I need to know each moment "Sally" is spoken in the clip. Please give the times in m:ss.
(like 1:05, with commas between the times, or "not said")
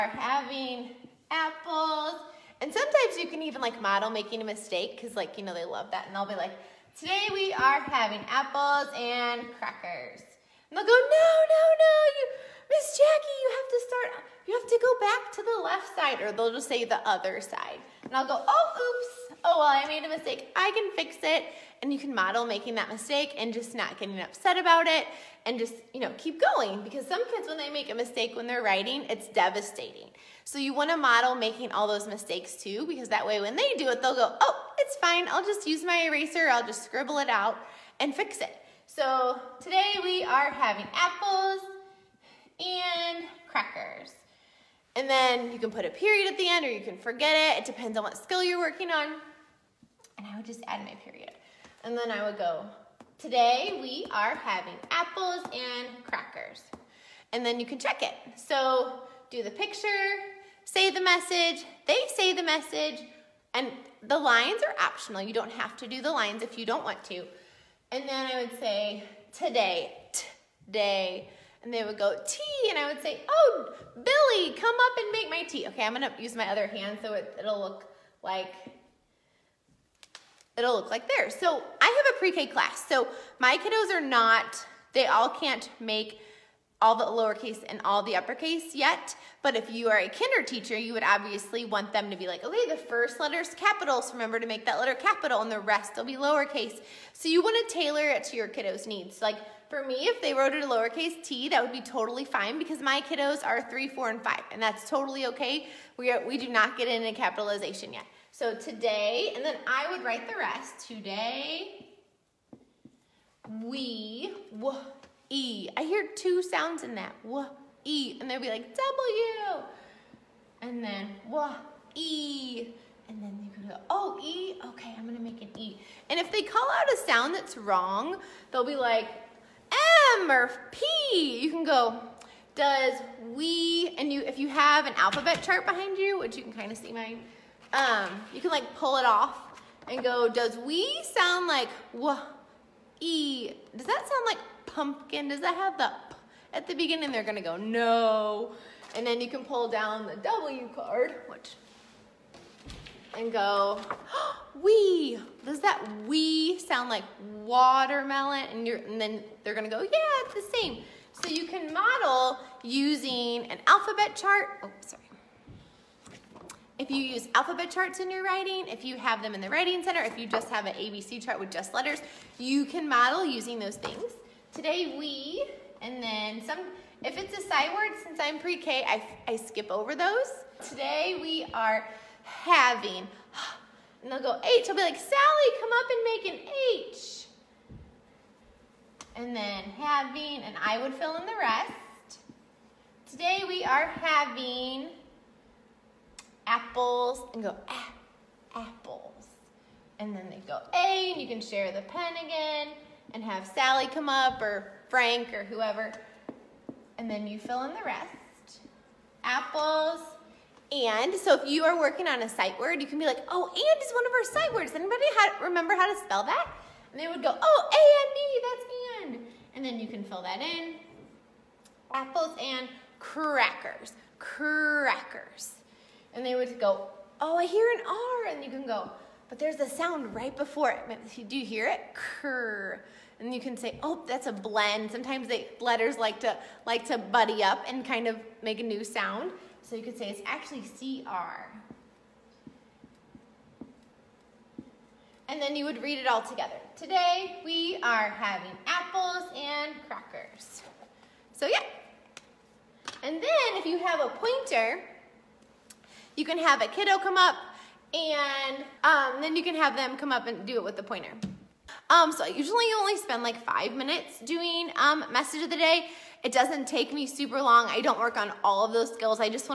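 3:04, 3:23.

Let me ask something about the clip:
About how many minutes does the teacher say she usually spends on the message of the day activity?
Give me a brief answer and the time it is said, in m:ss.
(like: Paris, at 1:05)
5 minutes, at 4:23.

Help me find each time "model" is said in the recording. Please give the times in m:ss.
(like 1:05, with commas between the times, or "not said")
0:03, 0:22, 0:30, 2:41, 2:52.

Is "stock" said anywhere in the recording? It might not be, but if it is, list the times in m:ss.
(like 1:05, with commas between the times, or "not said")
not said.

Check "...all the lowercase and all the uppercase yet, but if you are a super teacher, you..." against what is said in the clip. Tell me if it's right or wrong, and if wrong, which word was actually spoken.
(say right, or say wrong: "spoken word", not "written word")
wrong: "kinder", not "super".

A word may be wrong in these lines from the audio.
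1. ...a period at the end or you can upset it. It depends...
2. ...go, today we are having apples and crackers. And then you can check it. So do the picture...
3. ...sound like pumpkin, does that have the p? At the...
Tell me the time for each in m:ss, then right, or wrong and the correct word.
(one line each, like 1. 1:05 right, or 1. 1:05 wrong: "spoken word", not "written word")
1. 0:45 wrong: "forget", not "upset"
2. 0:52 right
3. 2:24 right.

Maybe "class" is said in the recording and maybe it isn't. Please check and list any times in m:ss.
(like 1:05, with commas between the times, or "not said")
1:22.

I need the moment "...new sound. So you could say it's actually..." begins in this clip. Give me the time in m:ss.
3:58.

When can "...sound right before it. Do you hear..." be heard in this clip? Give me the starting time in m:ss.
3:49.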